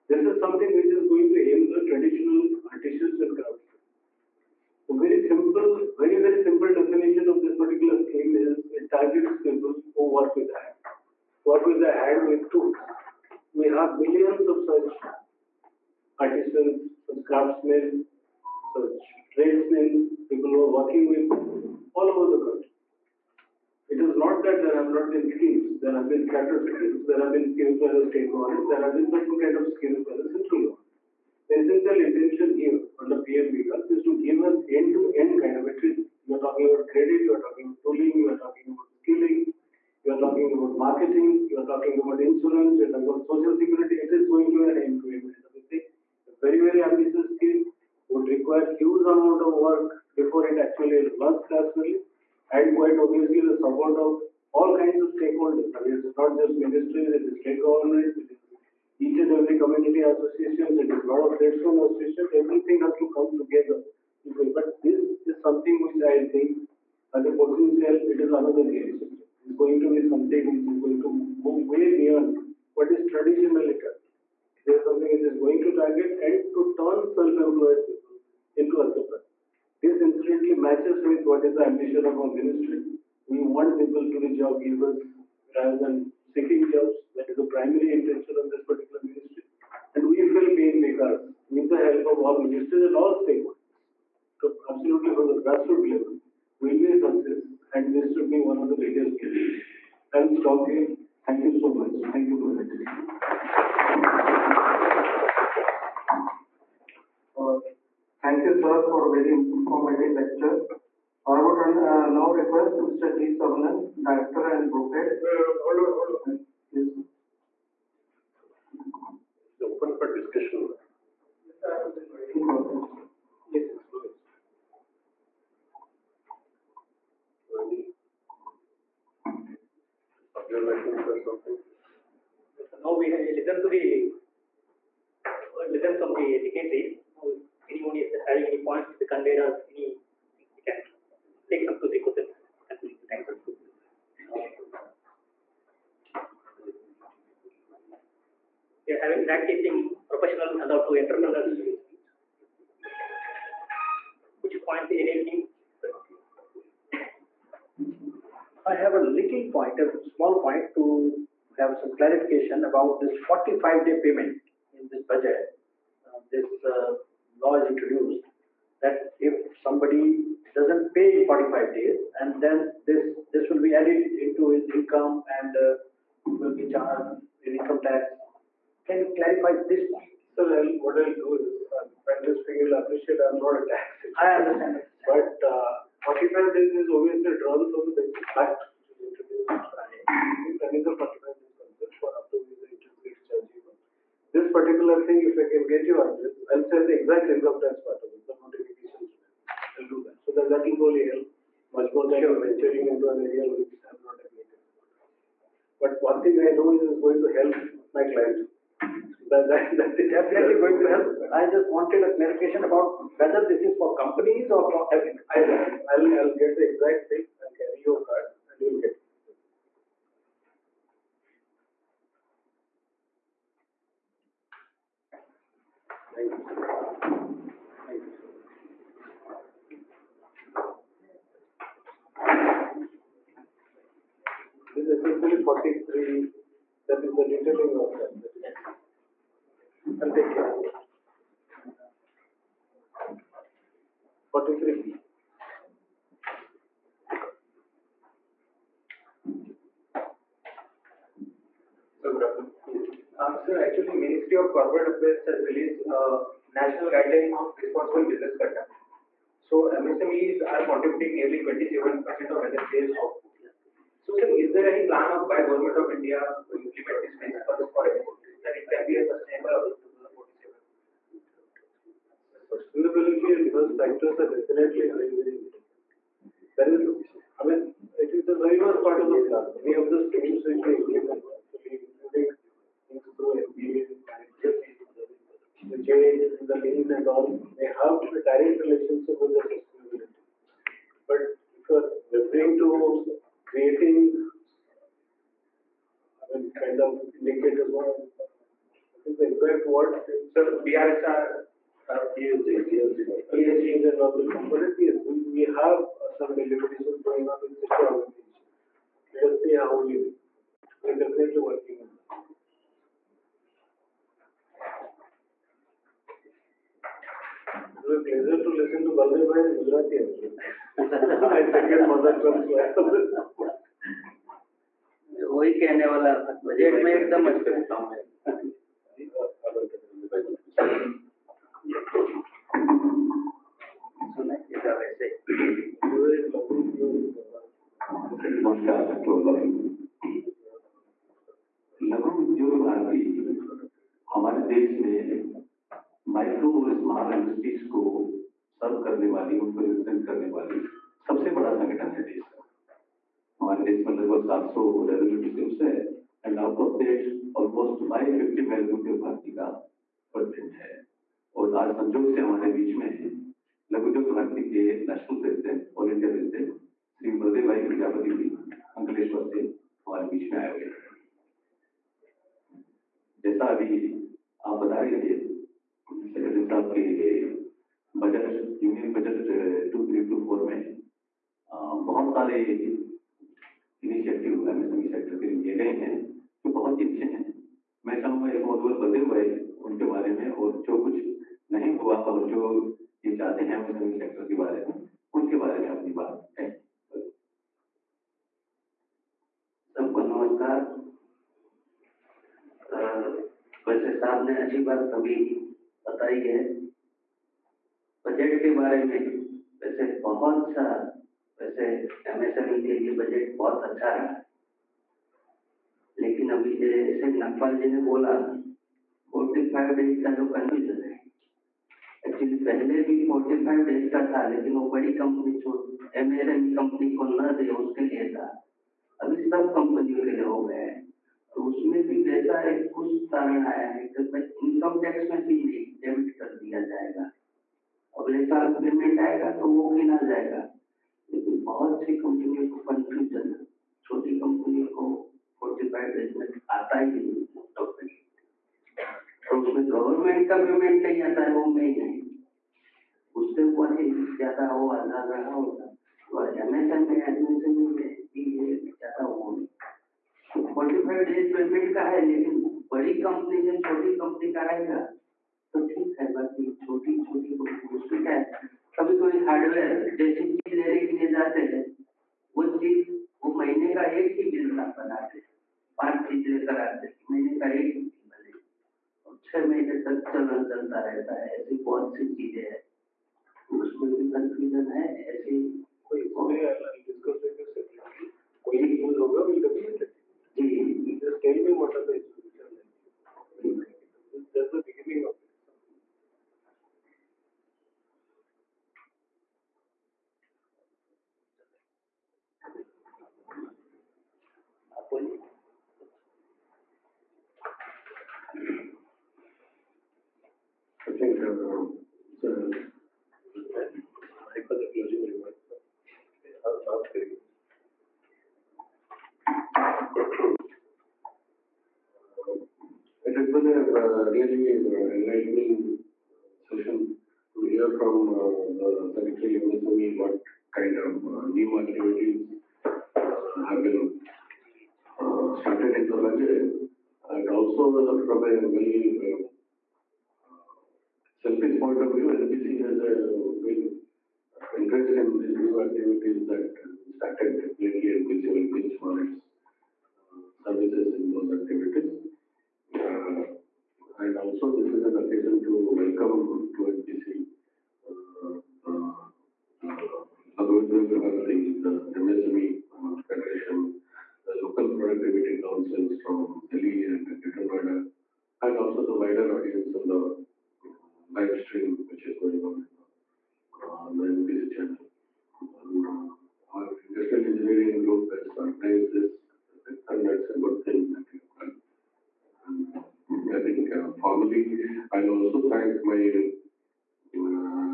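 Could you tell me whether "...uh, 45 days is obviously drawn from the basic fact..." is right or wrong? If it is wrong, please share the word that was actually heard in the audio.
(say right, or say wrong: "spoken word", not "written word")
right.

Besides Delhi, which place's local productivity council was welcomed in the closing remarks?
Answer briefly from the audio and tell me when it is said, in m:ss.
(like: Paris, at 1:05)
Greater Noida, at 9:27.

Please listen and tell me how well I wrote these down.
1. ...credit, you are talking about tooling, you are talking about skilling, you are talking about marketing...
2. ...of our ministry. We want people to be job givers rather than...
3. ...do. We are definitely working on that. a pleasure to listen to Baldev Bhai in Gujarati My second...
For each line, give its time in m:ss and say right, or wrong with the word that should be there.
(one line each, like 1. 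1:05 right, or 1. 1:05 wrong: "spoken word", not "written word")
1. 0:36 right
2. 1:22 right
3. 5:09 right.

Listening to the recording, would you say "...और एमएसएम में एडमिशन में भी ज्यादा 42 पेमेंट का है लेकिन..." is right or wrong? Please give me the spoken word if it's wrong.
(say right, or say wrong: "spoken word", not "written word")
wrong: "45", not "42".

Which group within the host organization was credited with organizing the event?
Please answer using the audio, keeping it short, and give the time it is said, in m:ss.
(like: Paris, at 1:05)
Industrial Engineering Group, at 9:36.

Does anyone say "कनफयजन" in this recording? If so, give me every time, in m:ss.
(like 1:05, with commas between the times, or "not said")
7:00.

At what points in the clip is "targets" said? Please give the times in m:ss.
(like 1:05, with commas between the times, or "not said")
0:08, 1:15.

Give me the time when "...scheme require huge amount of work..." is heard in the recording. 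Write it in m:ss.
0:47.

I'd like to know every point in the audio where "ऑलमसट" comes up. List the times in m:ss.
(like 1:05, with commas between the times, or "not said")
5:57.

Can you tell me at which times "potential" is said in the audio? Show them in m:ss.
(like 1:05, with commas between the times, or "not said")
1:07.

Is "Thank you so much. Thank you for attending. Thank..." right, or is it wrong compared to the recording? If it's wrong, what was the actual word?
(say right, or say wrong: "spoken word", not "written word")
right.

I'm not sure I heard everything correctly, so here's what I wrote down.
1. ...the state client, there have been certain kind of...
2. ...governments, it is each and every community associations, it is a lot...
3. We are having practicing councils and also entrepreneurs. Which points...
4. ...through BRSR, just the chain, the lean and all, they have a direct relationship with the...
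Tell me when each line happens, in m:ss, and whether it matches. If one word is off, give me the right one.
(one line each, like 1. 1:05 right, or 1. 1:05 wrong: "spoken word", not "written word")
1. 0:27 wrong: "government", not "client"
2. 0:57 right
3. 2:28 wrong: "professionals", not "councils"
4. 4:43 wrong: "MBA", not "BRSR".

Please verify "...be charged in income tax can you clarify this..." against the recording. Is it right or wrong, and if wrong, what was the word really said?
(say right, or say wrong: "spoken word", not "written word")
right.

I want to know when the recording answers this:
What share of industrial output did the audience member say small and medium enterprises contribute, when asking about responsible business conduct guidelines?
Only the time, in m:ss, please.
4:21.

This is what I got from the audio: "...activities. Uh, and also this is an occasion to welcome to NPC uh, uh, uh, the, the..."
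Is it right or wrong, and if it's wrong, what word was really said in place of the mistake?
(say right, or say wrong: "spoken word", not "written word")
right.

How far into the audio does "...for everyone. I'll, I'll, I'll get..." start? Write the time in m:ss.
3:34.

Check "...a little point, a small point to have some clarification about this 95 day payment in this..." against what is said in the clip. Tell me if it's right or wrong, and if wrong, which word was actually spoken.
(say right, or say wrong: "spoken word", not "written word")
wrong: "45", not "95".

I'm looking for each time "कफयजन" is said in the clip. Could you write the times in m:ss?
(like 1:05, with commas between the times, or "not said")
7:22, 8:04.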